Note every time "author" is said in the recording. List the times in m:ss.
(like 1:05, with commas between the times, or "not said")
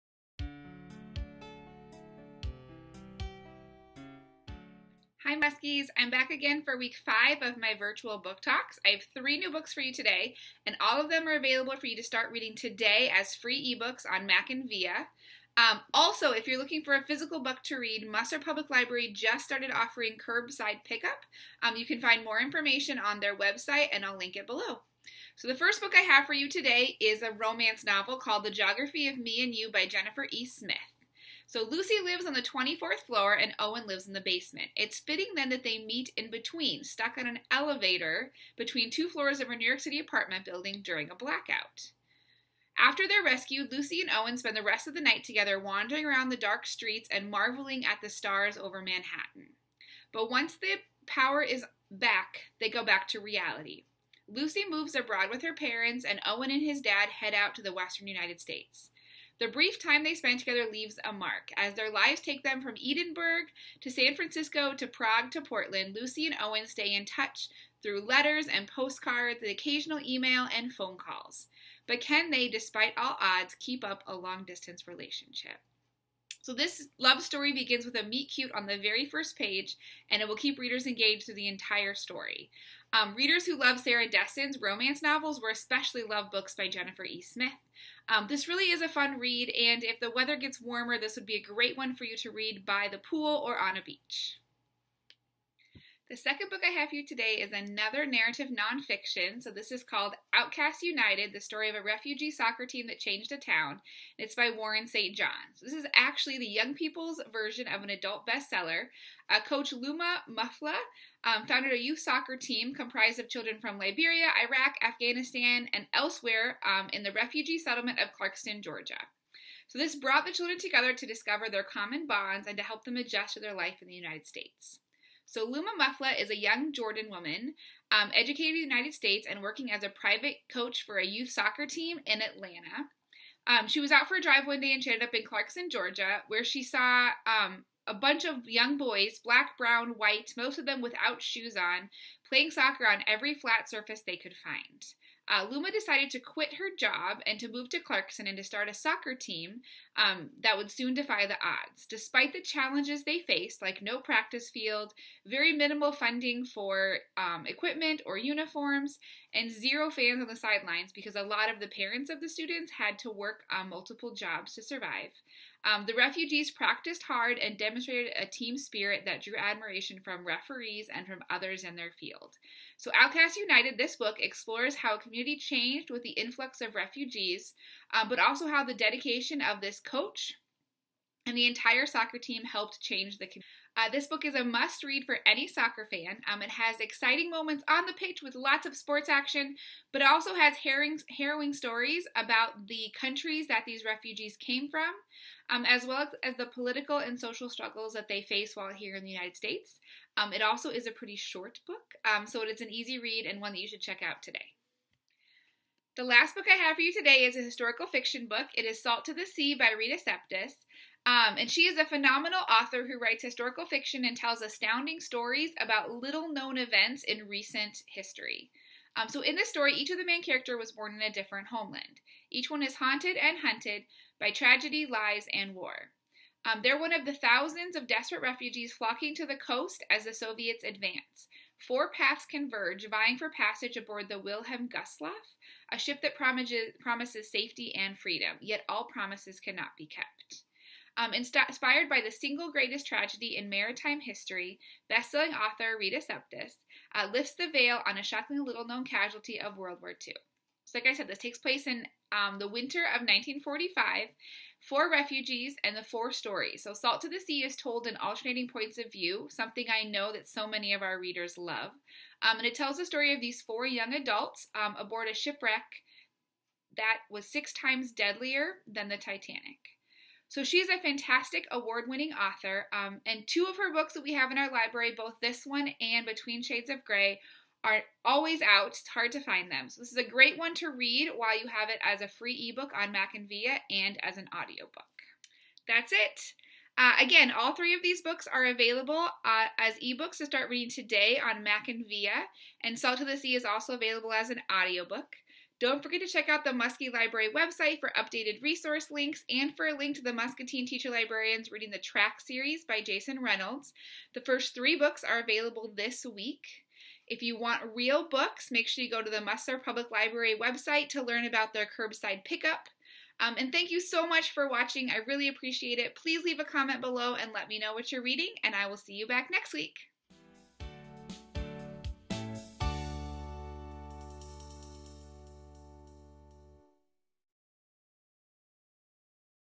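3:32, 4:05, 4:32.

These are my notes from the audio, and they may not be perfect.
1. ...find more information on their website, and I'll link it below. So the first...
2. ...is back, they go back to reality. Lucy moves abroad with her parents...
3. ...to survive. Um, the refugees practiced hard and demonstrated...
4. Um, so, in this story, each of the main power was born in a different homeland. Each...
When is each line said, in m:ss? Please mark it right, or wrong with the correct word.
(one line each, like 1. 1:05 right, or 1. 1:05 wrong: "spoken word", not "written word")
1. 0:22 right
2. 0:51 right
3. 2:44 right
4. 3:38 wrong: "character", not "power".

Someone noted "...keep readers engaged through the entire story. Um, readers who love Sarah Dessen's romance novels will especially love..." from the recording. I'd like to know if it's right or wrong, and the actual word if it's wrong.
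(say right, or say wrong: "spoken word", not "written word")
right.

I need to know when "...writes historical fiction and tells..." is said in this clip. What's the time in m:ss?
3:32.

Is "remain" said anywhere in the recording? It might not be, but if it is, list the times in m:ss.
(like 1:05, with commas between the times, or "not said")
not said.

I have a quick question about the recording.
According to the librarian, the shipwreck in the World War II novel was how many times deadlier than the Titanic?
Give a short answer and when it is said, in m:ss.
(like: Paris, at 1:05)
6, at 4:27.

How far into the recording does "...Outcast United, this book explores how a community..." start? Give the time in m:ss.
2:52.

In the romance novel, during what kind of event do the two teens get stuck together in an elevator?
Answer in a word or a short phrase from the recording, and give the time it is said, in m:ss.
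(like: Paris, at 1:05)
A blackout, at 0:41.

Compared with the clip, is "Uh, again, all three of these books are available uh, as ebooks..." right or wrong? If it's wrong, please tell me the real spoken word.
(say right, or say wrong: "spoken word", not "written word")
right.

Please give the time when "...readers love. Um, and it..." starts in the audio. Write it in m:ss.
4:20.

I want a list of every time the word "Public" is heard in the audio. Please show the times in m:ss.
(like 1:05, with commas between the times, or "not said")
0:18, 5:09.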